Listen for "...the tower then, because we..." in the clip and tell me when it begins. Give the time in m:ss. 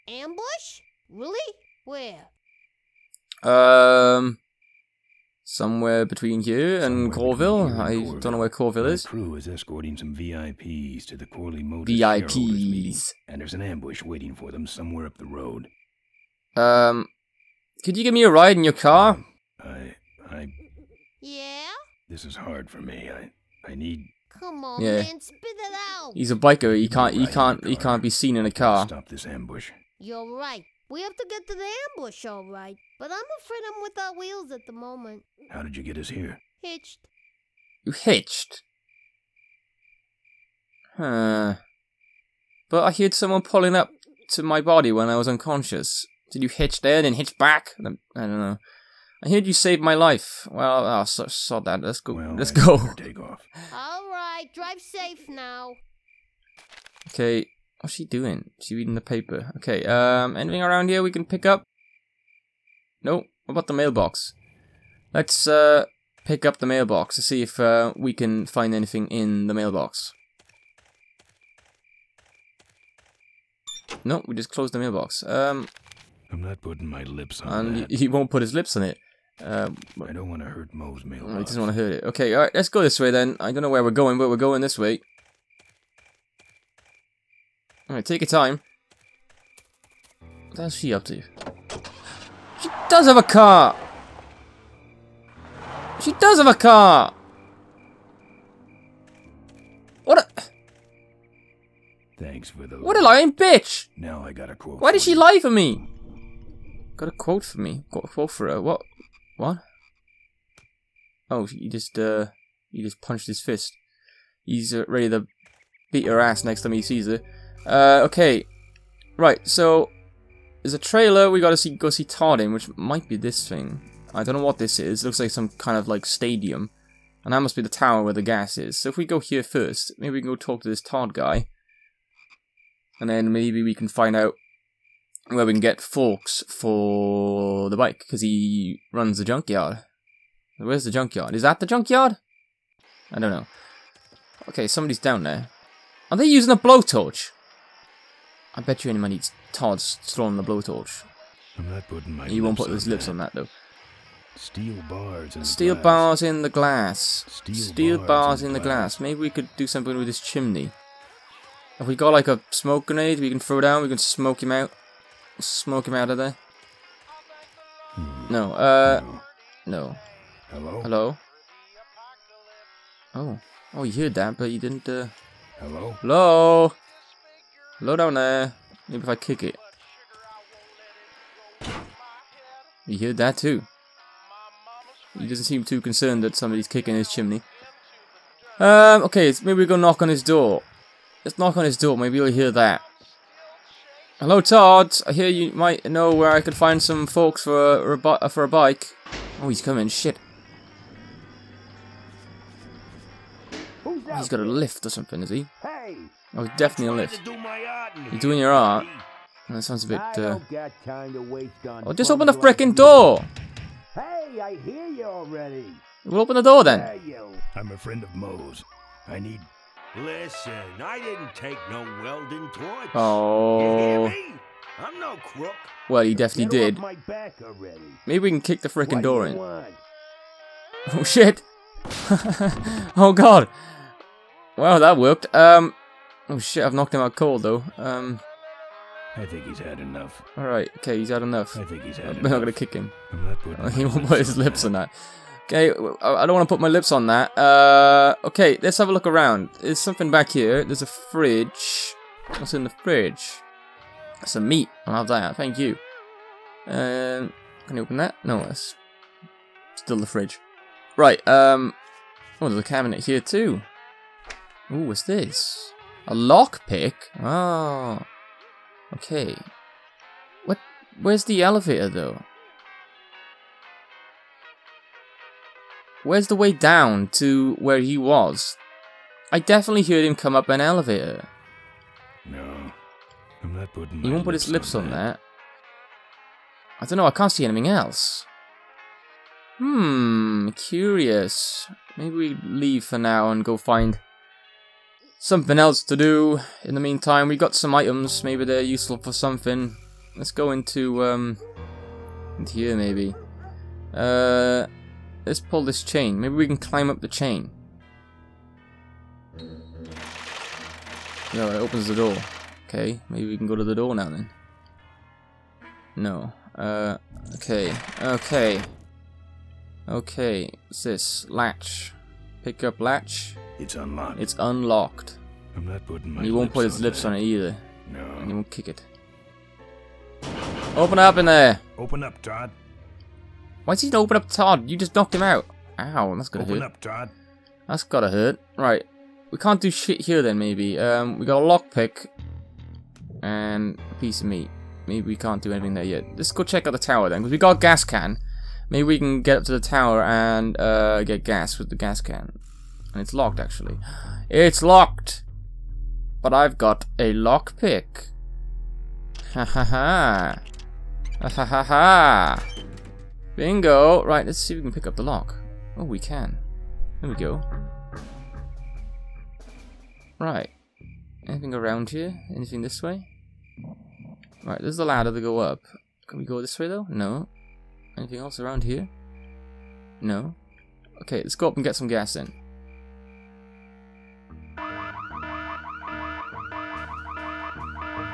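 5:46.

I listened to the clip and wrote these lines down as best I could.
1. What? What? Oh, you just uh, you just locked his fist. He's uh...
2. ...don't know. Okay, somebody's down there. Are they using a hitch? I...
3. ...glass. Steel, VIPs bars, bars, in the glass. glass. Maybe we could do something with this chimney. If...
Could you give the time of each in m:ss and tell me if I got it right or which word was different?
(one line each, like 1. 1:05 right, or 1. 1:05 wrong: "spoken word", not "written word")
1. 1:48 wrong: "punched", not "locked"
2. 2:23 wrong: "blowtorch", not "hitch"
3. 2:36 wrong: "Steel", not "VIPs".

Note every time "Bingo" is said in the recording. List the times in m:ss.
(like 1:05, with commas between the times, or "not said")
6:03.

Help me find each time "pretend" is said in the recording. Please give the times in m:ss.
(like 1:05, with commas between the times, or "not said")
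not said.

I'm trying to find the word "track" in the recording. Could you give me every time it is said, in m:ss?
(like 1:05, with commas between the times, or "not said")
not said.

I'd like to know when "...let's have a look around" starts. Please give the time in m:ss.
4:08.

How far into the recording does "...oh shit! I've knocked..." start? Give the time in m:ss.
3:56.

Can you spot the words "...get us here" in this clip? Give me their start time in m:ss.
0:35.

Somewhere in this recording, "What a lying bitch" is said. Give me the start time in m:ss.
1:42.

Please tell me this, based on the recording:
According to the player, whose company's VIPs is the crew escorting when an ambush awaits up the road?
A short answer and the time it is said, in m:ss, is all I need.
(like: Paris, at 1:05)
Corley Motors, at 0:11.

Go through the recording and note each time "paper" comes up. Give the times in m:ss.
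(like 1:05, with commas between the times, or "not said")
0:59.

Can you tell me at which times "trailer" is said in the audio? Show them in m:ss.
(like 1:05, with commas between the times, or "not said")
2:00.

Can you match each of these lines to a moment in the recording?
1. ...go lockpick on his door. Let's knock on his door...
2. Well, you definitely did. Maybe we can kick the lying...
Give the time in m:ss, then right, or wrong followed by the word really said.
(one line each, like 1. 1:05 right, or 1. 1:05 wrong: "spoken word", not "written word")
1. 3:09 wrong: "knock", not "lockpick"
2. 3:45 wrong: "freaking", not "lying".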